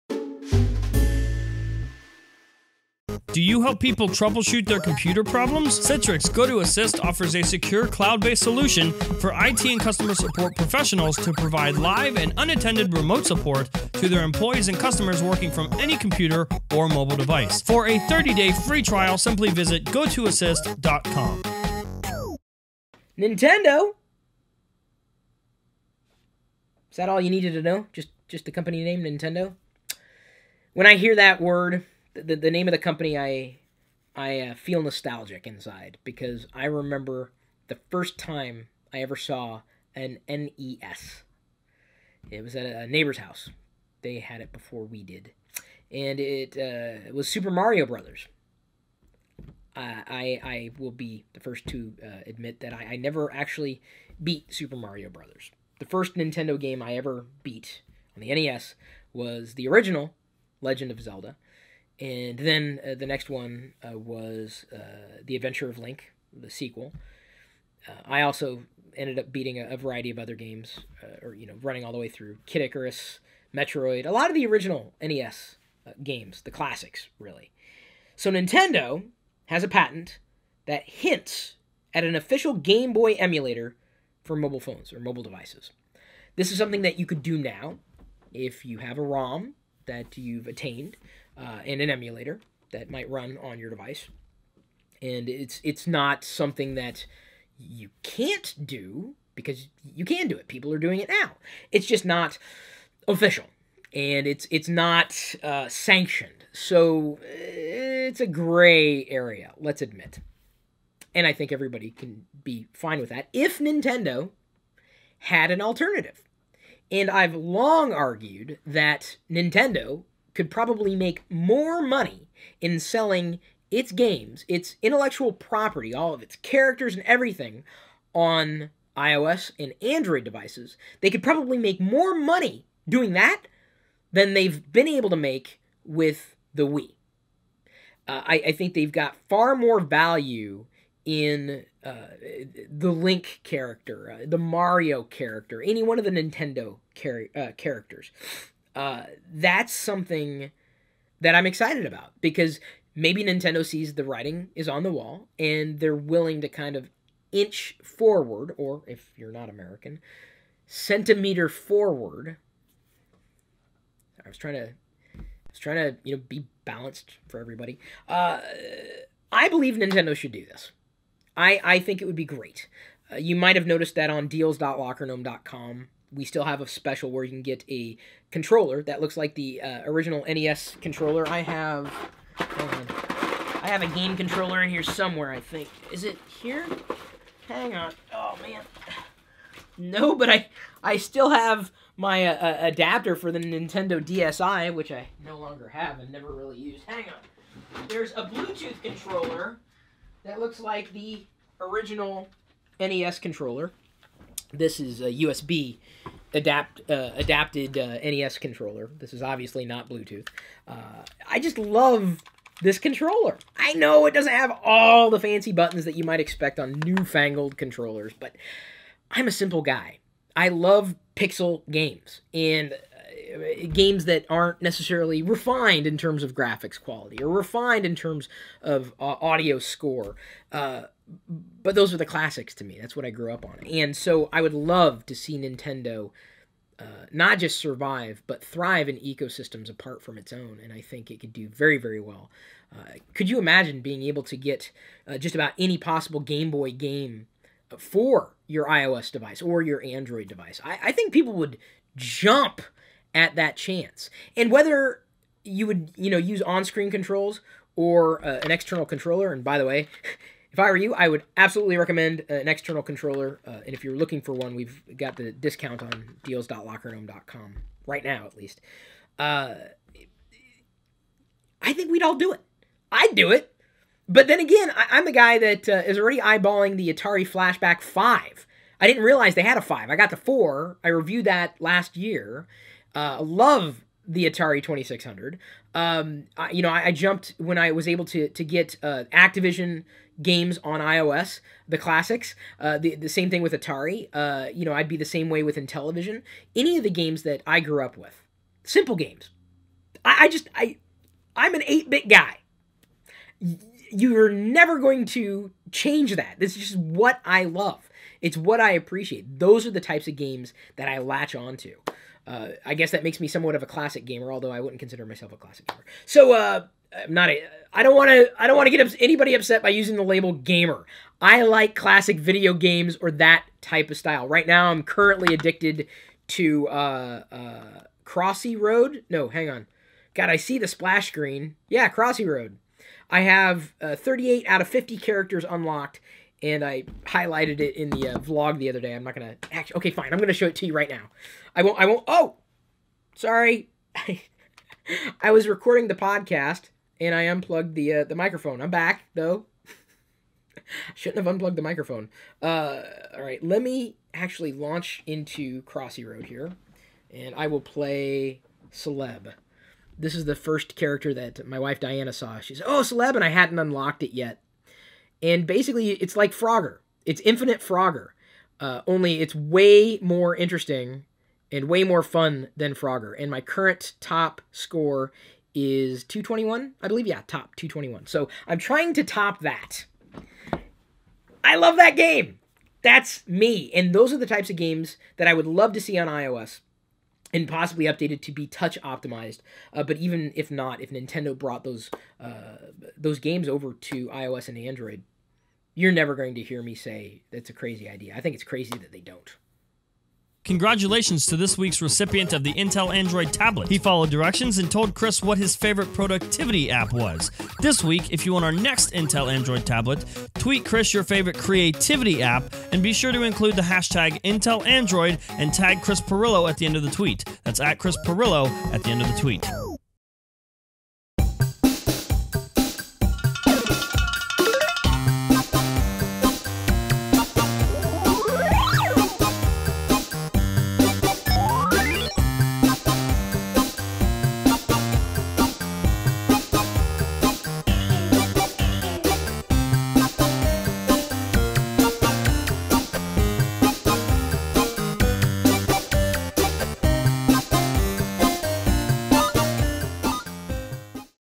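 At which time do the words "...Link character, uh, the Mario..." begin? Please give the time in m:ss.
2:22.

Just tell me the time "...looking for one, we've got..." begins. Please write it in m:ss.
4:23.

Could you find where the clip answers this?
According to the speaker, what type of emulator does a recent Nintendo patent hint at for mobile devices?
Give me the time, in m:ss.
1:22.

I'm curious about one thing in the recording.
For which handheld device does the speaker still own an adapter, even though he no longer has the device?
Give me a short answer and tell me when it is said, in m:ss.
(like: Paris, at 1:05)
Nintendo DSi, at 3:13.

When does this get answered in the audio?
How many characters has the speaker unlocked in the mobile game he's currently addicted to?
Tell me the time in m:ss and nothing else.
5:33.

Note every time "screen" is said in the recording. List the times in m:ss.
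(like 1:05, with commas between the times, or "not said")
4:16, 5:31.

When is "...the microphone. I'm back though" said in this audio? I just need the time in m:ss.
5:48.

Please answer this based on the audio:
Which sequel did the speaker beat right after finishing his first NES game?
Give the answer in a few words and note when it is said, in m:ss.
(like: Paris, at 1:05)
The Adventure of Link, at 1:05.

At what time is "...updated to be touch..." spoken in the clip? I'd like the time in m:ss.
6:27.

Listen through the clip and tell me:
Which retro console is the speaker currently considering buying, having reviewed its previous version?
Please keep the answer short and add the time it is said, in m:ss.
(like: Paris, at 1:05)
Atari Flashback 5, at 4:36.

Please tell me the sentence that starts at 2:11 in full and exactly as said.
They could probably make more money doing that than they've been able to make with the Wii.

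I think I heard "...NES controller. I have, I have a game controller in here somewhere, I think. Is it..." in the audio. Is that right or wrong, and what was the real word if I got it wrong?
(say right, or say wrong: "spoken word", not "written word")
right.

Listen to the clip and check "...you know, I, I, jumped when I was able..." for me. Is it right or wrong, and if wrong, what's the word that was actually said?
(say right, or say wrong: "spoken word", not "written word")
right.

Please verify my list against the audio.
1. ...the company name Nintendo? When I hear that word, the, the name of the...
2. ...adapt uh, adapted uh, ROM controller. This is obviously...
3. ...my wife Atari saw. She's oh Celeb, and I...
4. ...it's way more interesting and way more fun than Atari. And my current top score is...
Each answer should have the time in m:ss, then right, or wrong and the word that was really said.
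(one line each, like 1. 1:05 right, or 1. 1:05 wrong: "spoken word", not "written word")
1. 0:28 right
2. 3:26 wrong: "NES", not "ROM"
3. 6:01 wrong: "Diana", not "Atari"
4. 6:09 wrong: "Frogger", not "Atari".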